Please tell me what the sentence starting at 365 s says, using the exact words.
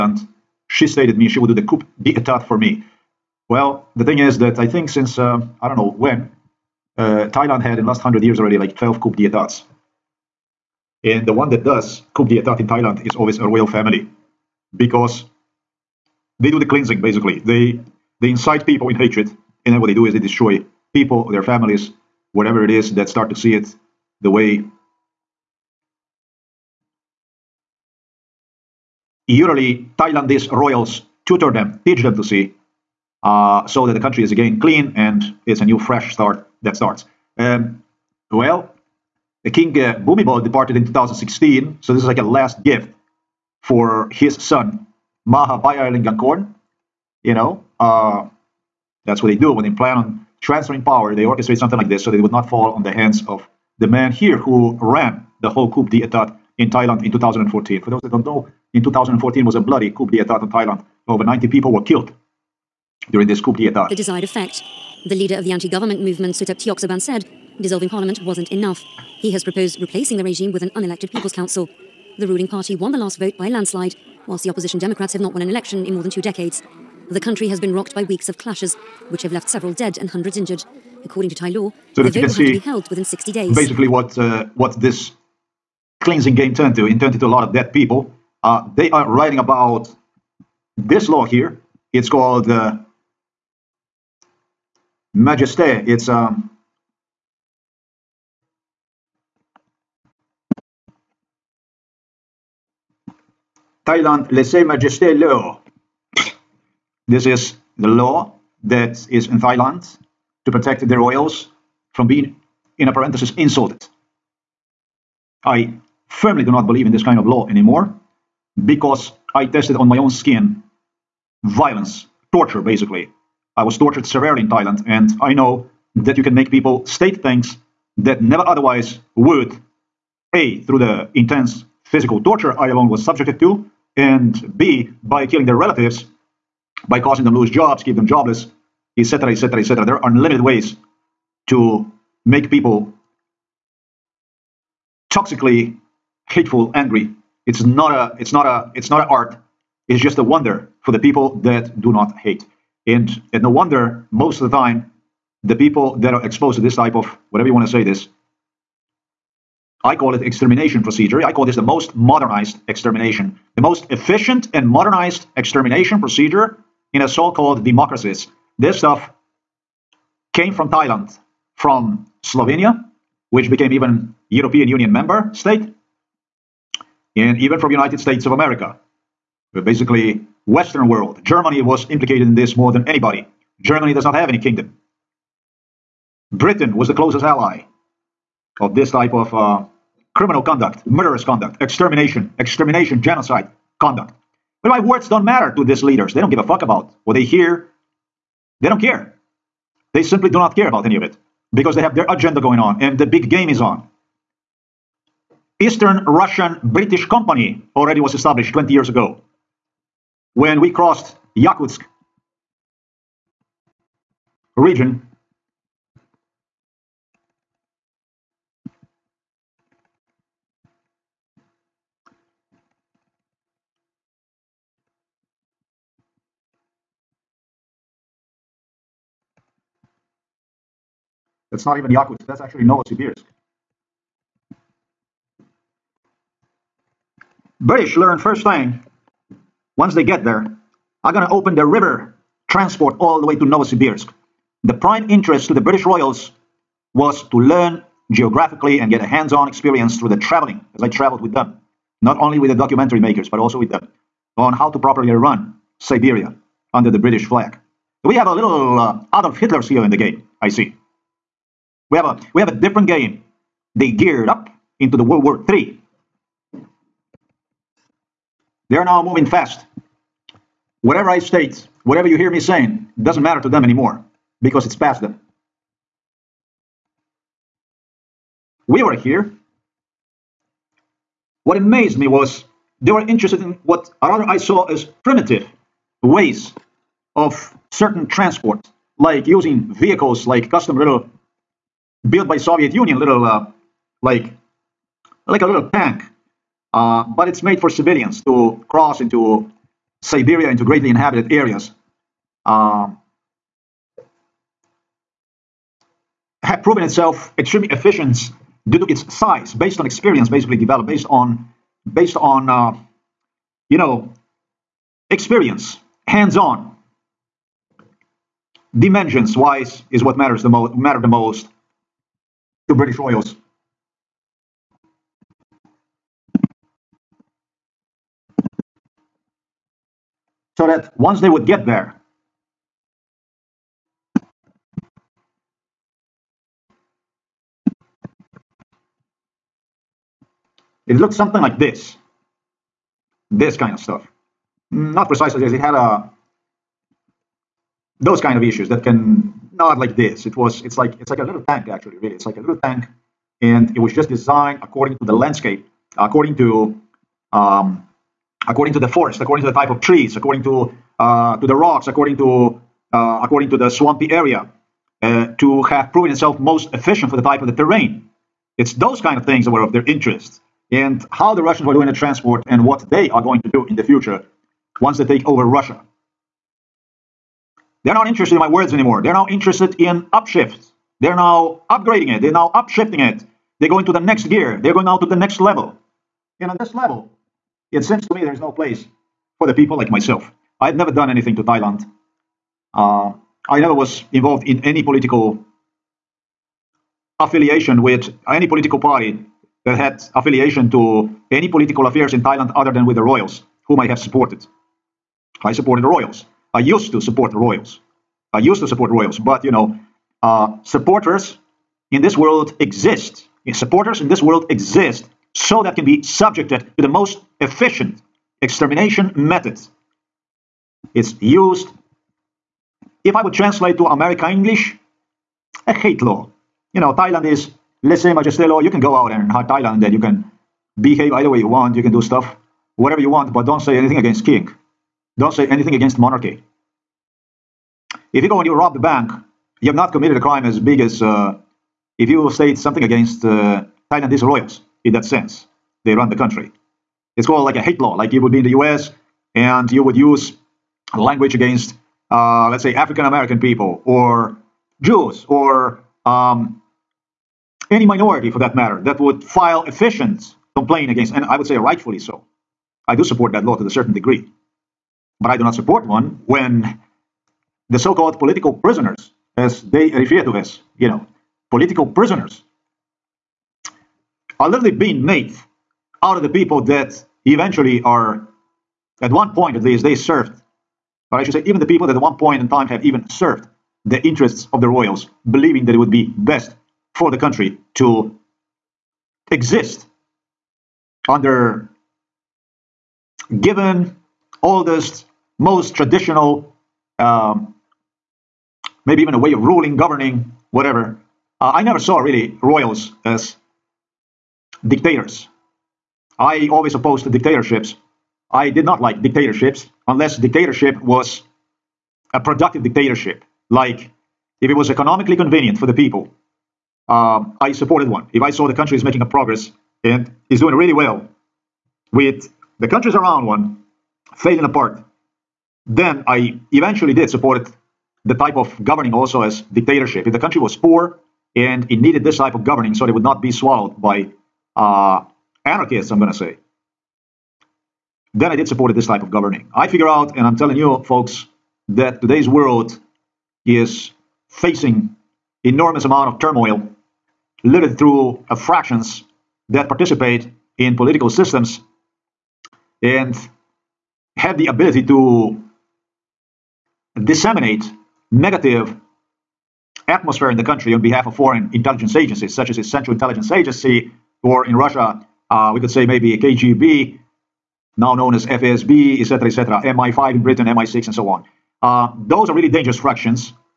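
Uh, to have proven itself most efficient for the type of the terrain.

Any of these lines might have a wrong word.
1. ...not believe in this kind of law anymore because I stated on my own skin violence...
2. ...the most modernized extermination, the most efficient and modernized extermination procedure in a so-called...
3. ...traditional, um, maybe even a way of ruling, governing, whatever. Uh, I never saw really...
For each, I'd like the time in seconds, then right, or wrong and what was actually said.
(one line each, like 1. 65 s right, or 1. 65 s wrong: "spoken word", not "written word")
1. 116 s wrong: "tested", not "stated"
2. 161 s right
3. 495 s right.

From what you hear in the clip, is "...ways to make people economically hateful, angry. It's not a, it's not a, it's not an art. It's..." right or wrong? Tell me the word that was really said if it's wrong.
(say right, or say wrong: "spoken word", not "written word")
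wrong: "toxically", not "economically".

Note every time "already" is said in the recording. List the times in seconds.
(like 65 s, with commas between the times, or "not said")
8 s, 207 s.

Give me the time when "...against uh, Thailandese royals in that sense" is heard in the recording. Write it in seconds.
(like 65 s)
442 s.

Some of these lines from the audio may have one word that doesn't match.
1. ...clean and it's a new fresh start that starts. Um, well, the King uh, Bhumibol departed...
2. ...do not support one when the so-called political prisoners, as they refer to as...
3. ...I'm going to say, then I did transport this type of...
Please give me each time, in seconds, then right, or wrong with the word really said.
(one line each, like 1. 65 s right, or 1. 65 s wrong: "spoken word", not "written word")
1. 34 s right
2. 465 s right
3. 535 s wrong: "support", not "transport".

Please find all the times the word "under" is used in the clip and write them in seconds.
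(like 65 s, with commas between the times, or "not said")
256 s, 491 s.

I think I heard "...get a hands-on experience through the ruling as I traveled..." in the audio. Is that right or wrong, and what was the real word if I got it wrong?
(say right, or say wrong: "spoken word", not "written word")
wrong: "traveling", not "ruling".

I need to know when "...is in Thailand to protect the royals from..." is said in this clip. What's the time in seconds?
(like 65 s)
109 s.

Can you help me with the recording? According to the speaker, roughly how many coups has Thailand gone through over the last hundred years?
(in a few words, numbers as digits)
12.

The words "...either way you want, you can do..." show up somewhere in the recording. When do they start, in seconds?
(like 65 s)
431 s.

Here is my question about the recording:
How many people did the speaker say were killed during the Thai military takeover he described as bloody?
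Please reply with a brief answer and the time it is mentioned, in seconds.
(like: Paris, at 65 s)
Over 90, at 61 s.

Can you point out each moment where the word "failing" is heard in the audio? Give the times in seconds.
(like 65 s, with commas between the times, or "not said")
524 s.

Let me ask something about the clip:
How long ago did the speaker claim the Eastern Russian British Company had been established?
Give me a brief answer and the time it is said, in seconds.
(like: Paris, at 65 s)
20 years ago, at 208 s.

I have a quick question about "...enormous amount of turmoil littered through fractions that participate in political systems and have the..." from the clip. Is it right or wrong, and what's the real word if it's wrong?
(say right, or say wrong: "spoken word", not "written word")
right.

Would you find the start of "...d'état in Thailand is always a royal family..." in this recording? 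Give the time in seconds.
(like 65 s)
12 s.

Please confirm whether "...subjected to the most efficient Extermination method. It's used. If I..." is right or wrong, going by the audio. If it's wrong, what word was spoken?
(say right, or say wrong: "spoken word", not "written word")
right.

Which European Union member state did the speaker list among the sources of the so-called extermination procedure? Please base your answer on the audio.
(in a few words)
Slovenia.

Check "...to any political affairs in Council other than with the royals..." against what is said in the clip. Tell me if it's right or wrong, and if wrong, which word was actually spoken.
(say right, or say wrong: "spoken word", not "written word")
wrong: "Thailand", not "Council".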